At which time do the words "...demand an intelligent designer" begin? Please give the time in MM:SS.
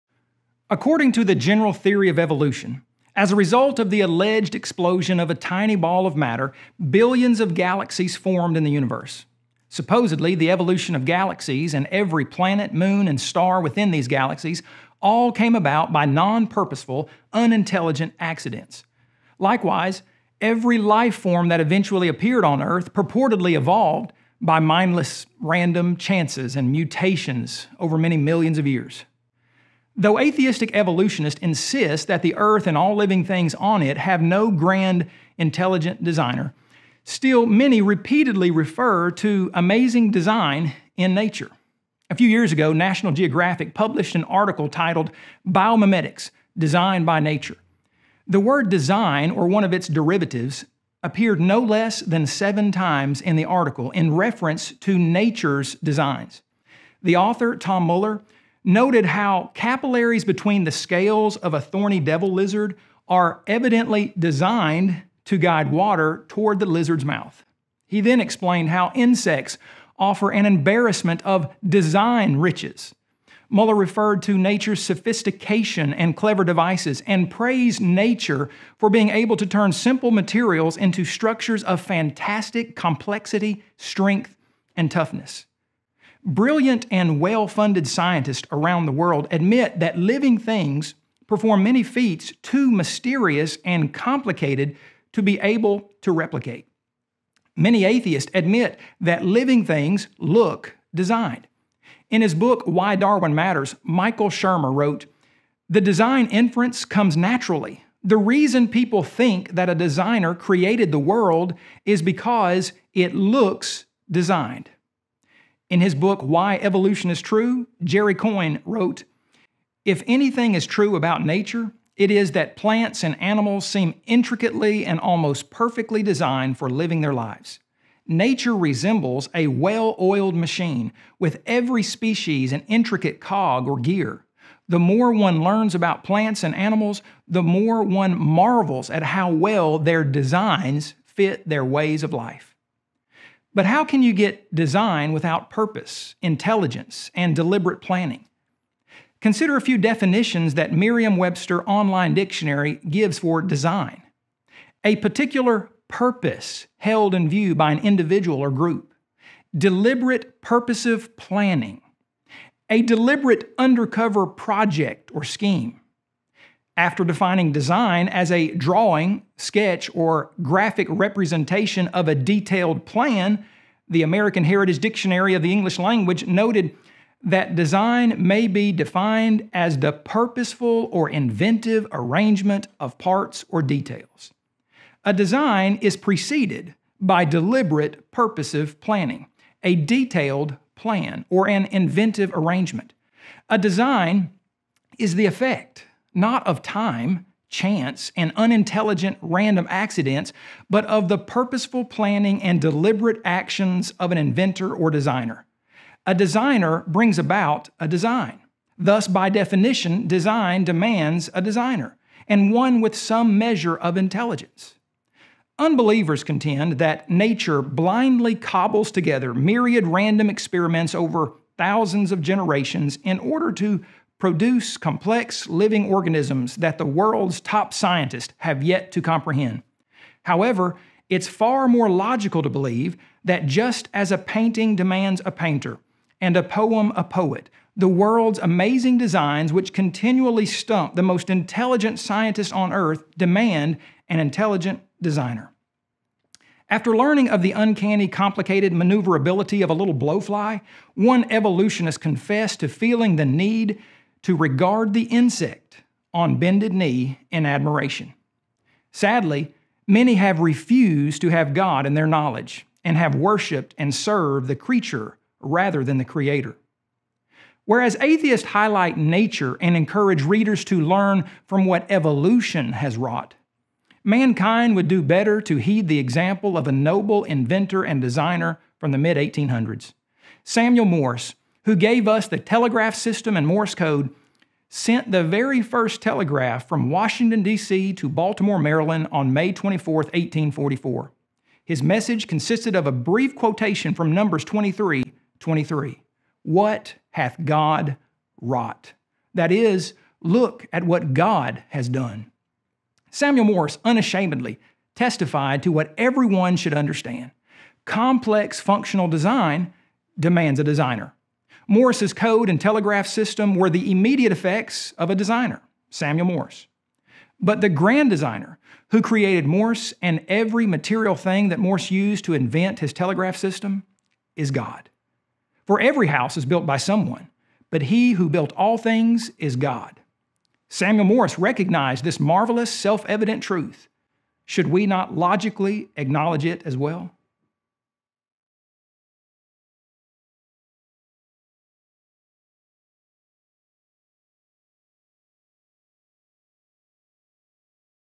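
04:03.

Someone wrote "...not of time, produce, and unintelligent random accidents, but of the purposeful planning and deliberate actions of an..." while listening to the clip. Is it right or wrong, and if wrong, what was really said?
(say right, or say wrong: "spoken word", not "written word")
wrong: "chance", not "produce".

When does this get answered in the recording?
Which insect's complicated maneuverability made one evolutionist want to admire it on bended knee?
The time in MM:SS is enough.
04:09.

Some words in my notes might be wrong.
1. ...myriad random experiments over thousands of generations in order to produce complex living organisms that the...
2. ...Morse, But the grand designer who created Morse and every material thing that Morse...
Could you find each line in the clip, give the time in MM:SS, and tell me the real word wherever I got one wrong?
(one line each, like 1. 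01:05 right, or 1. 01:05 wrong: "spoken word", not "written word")
1. 03:39 right
2. 05:16 right.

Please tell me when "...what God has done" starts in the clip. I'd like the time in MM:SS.
05:00.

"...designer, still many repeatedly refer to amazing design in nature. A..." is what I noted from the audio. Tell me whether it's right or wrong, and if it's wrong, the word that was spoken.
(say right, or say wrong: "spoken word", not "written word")
right.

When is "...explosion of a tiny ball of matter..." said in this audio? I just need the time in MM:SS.
00:04.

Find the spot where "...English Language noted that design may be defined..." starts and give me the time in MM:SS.
02:55.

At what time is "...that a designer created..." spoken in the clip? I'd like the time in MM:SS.
01:49.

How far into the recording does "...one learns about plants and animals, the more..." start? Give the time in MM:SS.
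02:15.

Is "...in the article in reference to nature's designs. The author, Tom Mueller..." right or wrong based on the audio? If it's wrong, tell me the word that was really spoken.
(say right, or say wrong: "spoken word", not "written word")
right.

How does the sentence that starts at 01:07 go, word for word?
He then explained how insects offer an embarrassment of design riches.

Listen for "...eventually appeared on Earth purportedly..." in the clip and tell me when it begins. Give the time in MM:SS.
00:21.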